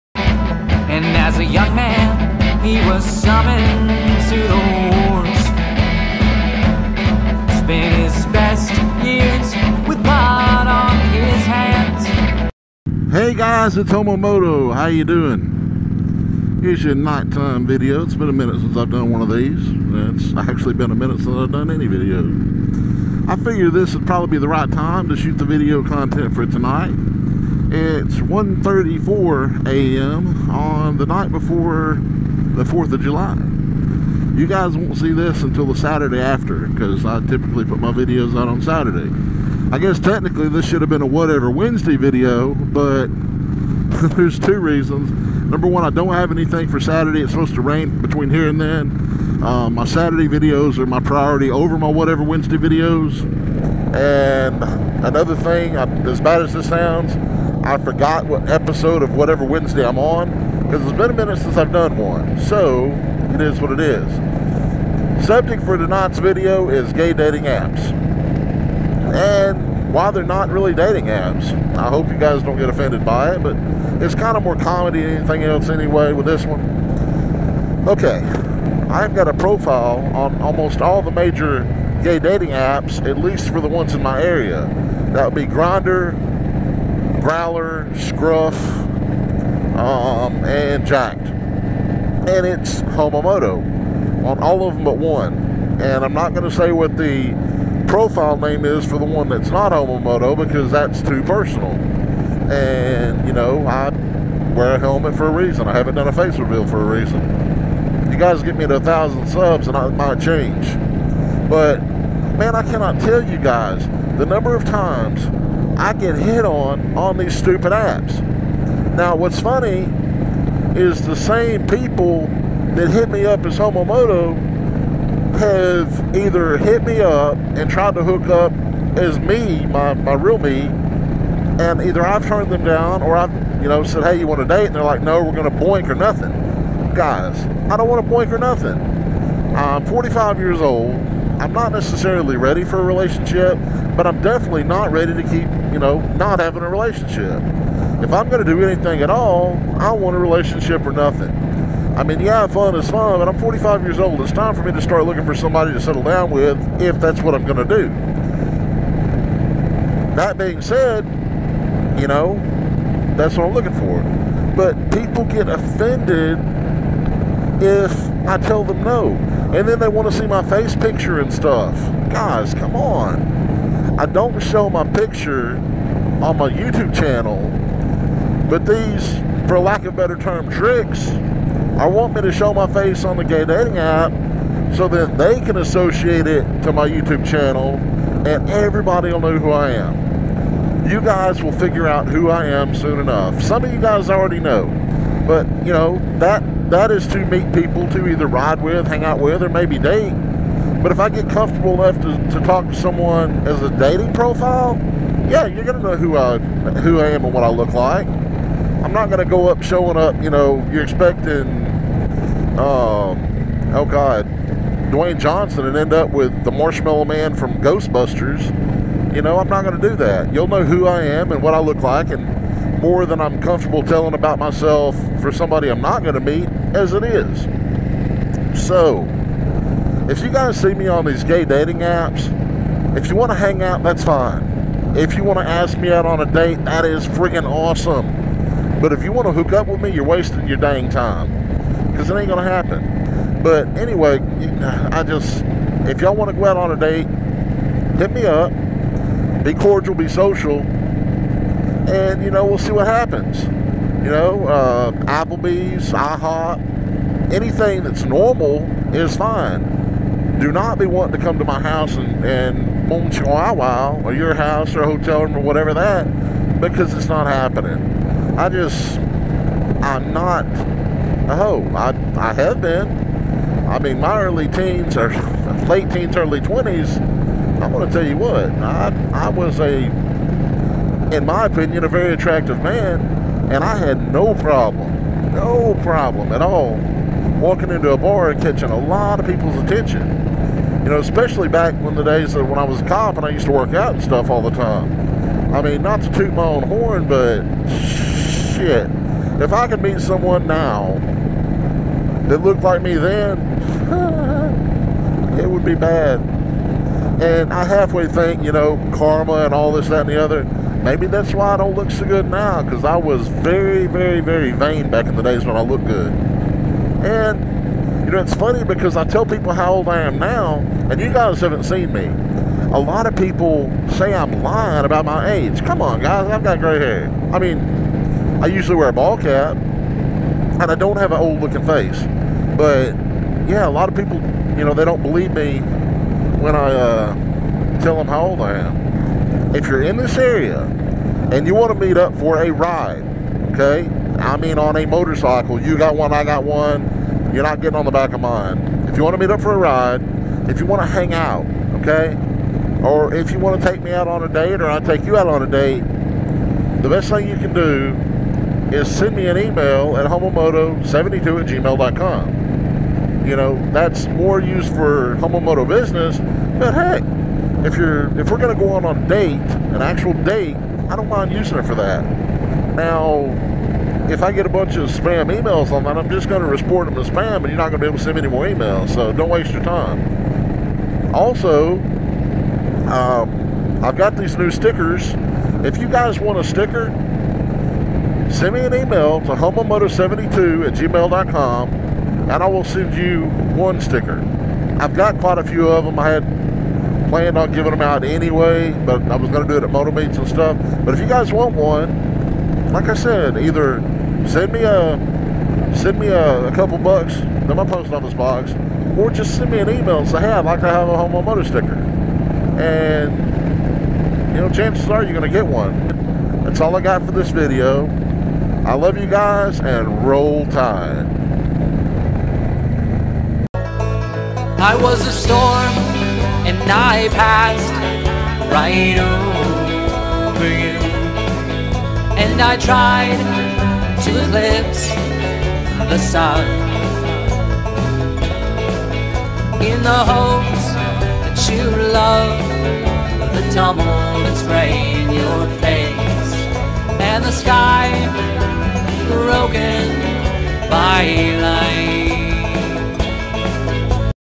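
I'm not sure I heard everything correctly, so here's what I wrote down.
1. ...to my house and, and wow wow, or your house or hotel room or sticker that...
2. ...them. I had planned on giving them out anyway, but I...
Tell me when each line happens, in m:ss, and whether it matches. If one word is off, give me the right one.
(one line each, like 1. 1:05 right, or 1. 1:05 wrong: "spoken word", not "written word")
1. 4:21 wrong: "whatever", not "sticker"
2. 6:35 right.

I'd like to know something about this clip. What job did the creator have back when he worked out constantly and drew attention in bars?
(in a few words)
cop.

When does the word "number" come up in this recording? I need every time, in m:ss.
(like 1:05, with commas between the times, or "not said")
0:45, 1:54.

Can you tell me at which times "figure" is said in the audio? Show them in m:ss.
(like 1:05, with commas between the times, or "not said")
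0:23, 3:11.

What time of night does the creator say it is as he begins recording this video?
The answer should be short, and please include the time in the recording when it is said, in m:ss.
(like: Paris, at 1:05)
1:34 a.m., at 0:28.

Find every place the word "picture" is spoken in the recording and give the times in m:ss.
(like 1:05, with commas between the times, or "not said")
2:50, 2:54.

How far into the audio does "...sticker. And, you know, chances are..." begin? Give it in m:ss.
6:51.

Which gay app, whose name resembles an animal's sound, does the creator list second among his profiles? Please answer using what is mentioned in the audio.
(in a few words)
Growlr.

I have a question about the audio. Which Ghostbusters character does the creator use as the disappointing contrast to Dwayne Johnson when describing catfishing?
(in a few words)
the marshmallow man.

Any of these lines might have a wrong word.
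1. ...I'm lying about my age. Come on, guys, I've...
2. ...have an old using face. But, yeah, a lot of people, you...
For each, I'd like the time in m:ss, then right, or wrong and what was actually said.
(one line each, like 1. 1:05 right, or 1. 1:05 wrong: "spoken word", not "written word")
1. 5:24 right
2. 5:30 wrong: "looking", not "using".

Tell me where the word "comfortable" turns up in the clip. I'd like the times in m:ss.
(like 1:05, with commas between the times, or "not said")
3:21, 3:43.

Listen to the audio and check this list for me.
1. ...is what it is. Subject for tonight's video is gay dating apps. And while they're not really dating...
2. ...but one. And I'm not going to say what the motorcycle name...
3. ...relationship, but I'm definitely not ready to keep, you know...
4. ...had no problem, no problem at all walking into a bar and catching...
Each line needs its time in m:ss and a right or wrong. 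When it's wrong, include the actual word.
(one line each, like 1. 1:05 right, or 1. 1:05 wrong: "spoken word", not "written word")
1. 1:03 right
2. 1:34 wrong: "profile", not "motorcycle"
3. 2:22 right
4. 4:43 right.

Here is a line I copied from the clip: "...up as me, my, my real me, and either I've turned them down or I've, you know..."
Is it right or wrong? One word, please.
right.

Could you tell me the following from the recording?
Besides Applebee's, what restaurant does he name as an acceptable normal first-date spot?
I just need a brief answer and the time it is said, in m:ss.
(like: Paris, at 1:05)
IHOP, at 4:15.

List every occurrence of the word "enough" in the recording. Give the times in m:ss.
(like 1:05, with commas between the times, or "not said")
3:13, 3:21.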